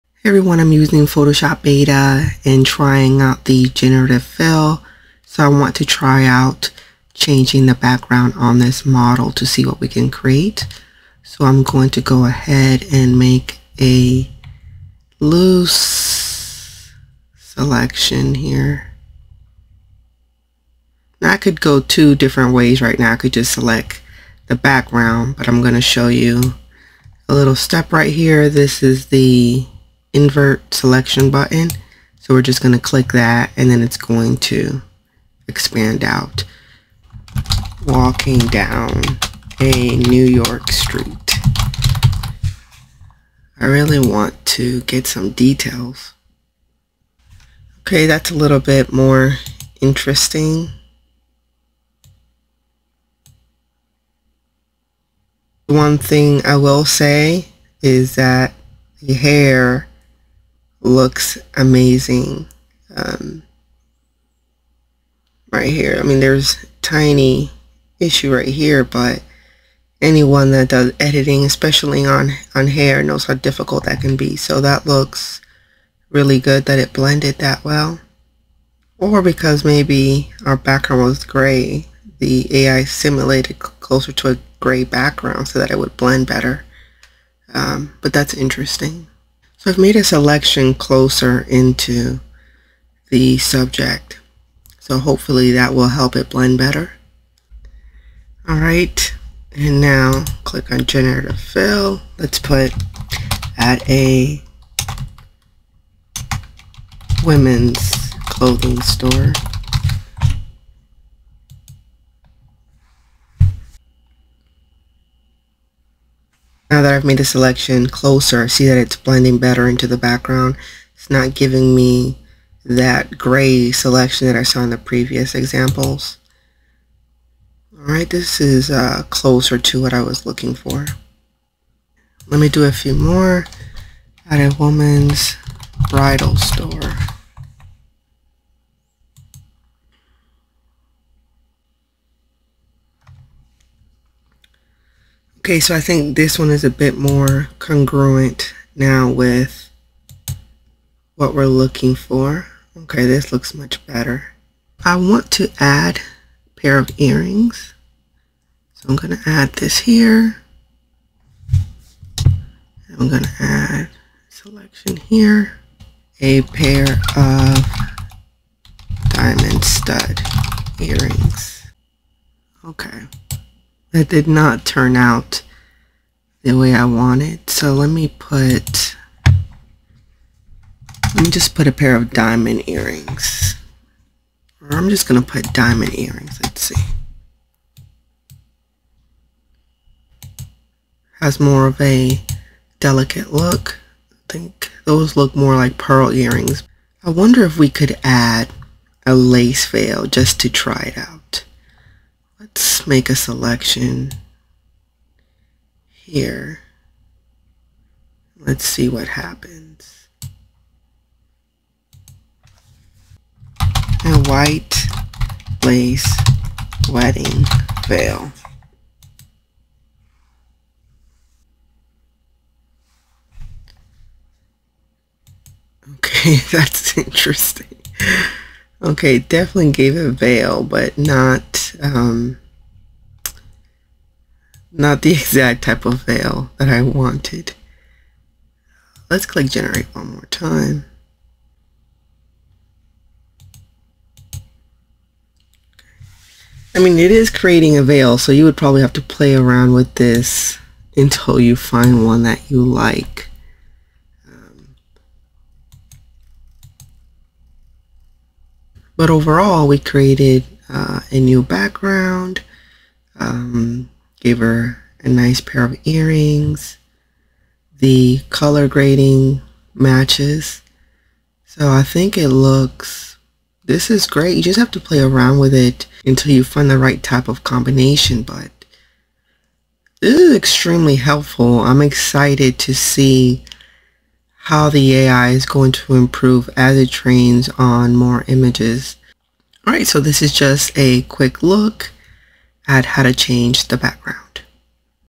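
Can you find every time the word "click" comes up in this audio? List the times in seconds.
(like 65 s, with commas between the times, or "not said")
32 s, 100 s, 239 s.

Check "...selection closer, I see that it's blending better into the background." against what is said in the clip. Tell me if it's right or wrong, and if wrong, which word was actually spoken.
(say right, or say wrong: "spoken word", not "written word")
right.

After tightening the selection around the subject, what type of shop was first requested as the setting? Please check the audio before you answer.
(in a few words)
women's clothing store.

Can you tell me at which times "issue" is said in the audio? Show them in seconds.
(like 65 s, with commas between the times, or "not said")
67 s.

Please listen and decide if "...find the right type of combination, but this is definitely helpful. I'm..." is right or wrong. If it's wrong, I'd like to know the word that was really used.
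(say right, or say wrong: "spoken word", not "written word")
wrong: "extremely", not "definitely".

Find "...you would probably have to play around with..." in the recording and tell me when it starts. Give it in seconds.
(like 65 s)
248 s.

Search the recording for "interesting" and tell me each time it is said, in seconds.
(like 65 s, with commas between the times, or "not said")
49 s, 88 s, 226 s.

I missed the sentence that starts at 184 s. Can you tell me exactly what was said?
Or I'm just going to put diamond earrings.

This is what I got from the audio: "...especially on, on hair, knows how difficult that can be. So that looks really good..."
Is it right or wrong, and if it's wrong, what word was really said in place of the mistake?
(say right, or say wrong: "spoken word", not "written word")
right.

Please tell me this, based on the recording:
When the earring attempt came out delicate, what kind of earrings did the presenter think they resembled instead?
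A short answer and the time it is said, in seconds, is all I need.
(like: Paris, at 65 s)
pearl earrings, at 195 s.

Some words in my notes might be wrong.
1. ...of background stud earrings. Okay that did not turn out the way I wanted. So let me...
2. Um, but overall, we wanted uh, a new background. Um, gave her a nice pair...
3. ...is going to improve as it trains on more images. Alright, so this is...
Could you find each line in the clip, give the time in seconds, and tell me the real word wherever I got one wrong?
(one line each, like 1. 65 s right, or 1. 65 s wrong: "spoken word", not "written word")
1. 167 s wrong: "diamond", not "background"
2. 254 s wrong: "created", not "wanted"
3. 285 s right.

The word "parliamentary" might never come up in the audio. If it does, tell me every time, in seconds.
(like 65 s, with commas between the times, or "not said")
not said.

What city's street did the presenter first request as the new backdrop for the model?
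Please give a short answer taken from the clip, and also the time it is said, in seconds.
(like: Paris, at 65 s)
New York, at 39 s.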